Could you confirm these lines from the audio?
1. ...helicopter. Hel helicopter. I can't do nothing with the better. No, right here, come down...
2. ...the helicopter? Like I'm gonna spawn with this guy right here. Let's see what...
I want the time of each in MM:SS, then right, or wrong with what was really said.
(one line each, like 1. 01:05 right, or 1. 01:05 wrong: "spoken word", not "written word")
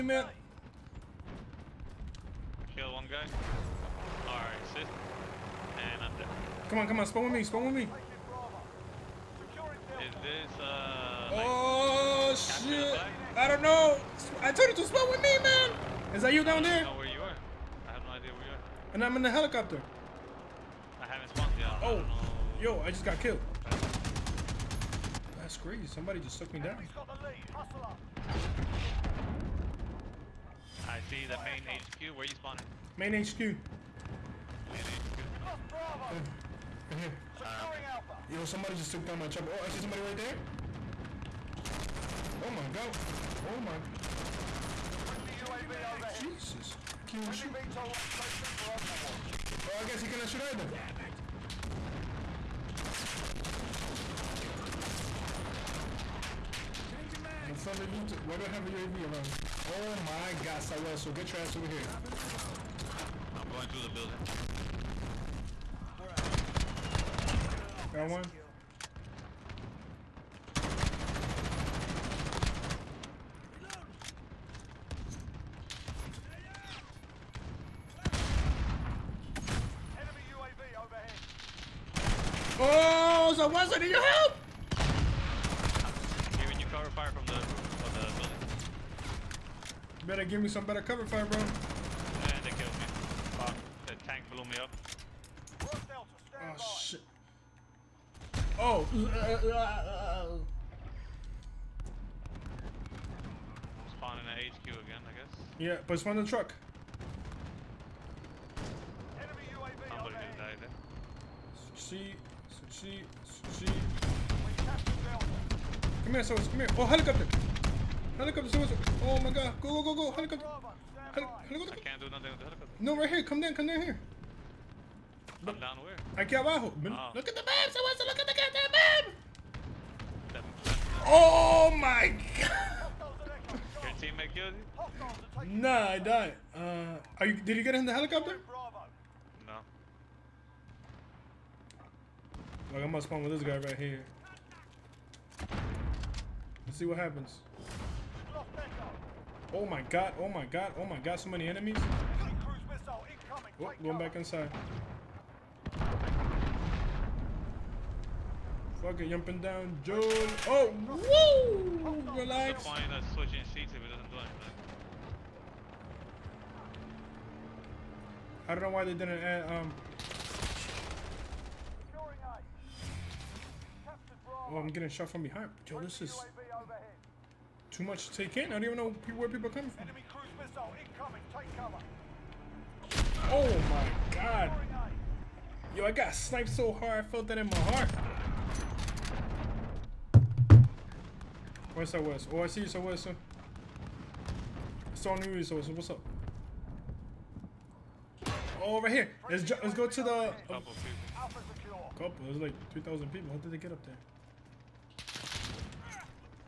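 1. 02:00 wrong: "helicopter", not "better"
2. 02:17 right.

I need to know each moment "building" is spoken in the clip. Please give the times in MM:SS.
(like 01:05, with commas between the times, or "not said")
01:03, 01:27.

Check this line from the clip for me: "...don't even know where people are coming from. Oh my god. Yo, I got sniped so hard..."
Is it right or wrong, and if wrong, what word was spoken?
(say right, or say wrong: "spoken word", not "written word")
right.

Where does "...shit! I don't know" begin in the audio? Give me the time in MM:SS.
00:12.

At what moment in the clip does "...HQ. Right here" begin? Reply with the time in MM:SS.
00:34.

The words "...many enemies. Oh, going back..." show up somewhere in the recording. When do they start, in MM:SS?
02:31.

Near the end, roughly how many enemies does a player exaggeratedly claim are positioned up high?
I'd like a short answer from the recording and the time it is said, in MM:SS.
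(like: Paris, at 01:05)
3,000, at 03:22.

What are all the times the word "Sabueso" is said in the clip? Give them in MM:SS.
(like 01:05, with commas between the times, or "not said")
01:00.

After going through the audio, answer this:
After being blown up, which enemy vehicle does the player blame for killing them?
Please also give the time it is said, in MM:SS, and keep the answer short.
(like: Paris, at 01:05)
The tank, at 01:33.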